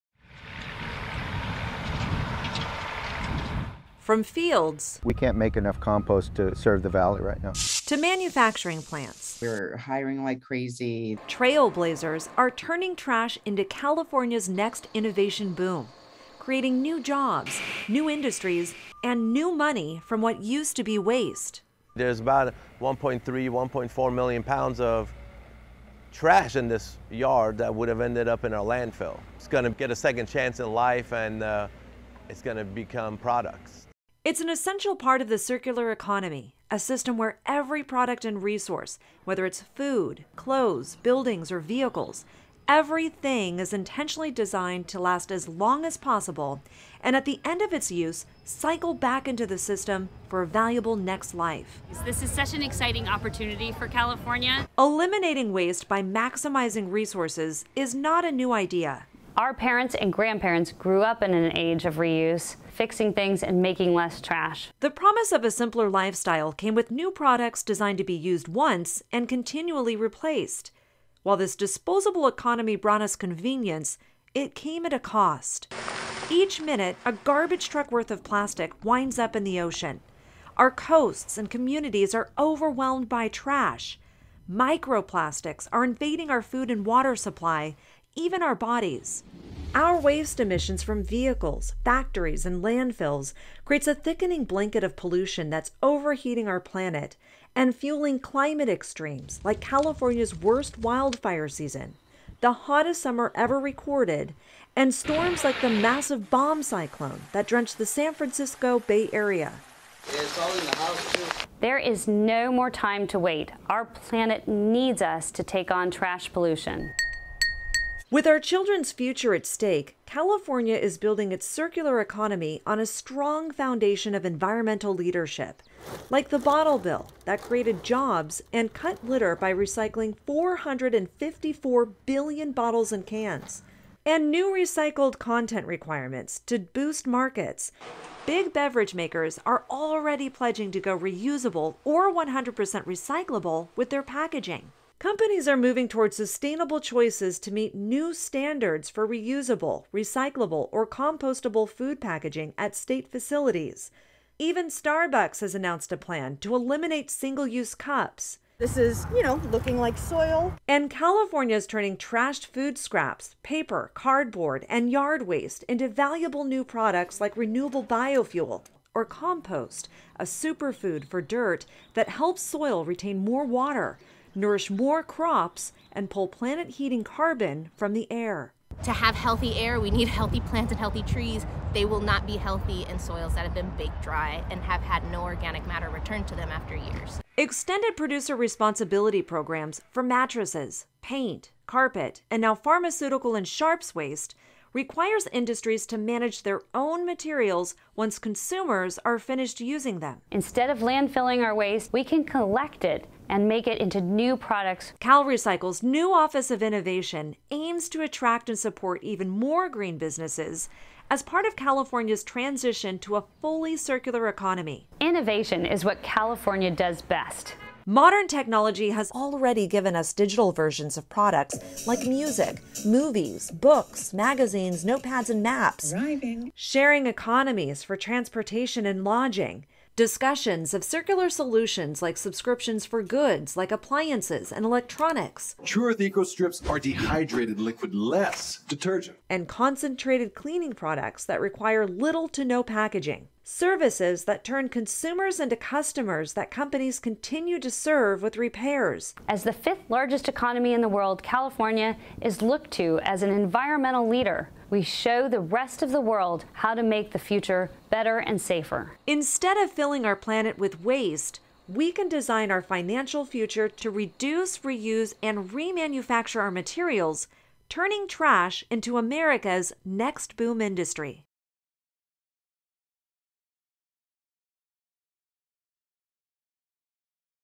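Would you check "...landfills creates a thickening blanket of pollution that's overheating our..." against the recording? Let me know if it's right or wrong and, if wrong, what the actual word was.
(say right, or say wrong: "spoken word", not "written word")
right.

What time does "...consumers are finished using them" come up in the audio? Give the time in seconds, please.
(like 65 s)
198 s.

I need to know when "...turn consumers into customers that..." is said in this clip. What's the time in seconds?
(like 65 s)
244 s.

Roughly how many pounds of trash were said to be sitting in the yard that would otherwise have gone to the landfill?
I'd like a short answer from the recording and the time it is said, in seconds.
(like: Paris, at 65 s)
1.4 million pounds, at 23 s.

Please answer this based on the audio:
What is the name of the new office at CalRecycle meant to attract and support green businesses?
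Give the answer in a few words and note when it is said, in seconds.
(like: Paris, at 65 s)
Office of Innovation, at 206 s.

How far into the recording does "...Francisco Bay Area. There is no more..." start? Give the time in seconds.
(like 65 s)
108 s.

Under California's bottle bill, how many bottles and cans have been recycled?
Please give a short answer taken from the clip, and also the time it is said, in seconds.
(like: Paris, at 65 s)
454 billion, at 130 s.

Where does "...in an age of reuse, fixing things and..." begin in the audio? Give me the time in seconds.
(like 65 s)
61 s.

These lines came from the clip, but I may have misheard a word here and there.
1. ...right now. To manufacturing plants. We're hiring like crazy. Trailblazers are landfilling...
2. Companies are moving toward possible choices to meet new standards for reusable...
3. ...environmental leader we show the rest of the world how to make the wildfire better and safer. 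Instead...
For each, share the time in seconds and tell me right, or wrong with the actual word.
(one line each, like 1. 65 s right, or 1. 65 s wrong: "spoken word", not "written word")
1. 7 s wrong: "turning", not "landfilling"
2. 145 s wrong: "sustainable", not "possible"
3. 253 s wrong: "future", not "wildfire".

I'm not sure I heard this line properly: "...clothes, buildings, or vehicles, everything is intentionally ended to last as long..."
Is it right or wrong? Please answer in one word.
wrong.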